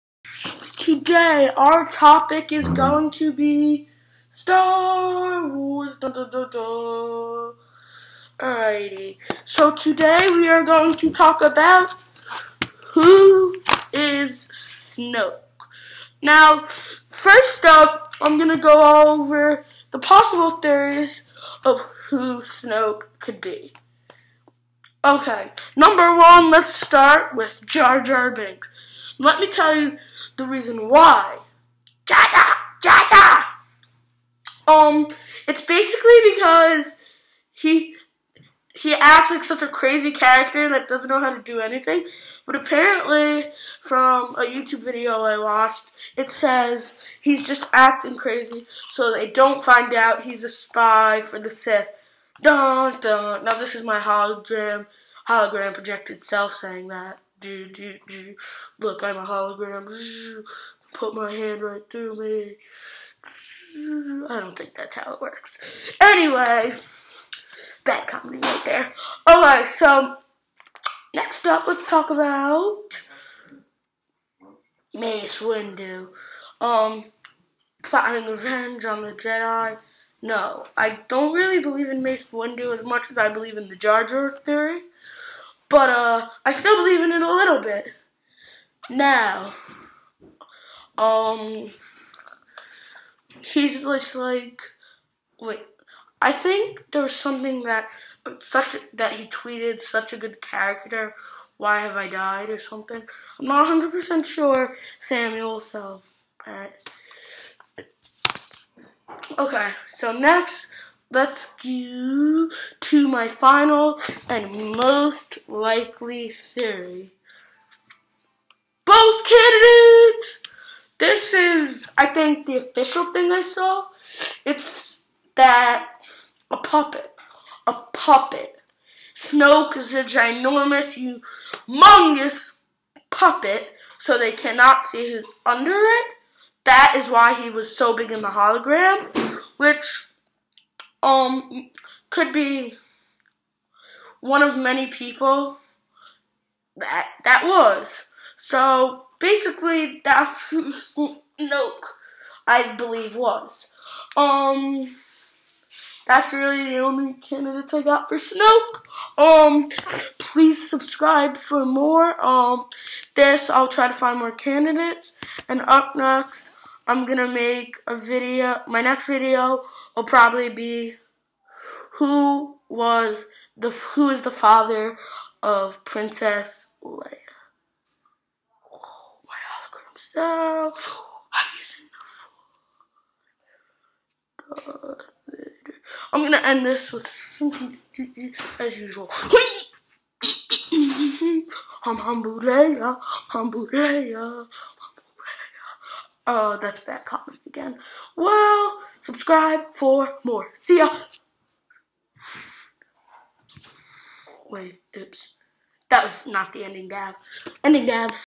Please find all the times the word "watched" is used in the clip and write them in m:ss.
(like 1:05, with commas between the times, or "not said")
0:45.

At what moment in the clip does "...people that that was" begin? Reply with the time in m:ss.
2:24.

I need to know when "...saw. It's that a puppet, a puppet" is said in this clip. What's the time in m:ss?
2:03.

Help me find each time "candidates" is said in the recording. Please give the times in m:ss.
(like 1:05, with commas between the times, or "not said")
1:59, 2:37, 2:44.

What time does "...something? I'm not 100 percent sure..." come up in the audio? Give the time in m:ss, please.
1:42.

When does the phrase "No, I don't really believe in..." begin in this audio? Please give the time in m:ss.
1:20.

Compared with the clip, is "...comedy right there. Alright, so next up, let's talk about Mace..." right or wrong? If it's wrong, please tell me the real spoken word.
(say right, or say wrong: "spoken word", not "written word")
right.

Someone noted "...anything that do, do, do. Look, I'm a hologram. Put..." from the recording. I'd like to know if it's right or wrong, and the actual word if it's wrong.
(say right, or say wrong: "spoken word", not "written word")
wrong: "saying", not "anything".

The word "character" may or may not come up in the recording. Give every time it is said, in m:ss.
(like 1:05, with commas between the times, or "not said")
0:40, 1:40.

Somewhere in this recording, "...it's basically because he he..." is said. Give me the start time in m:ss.
0:35.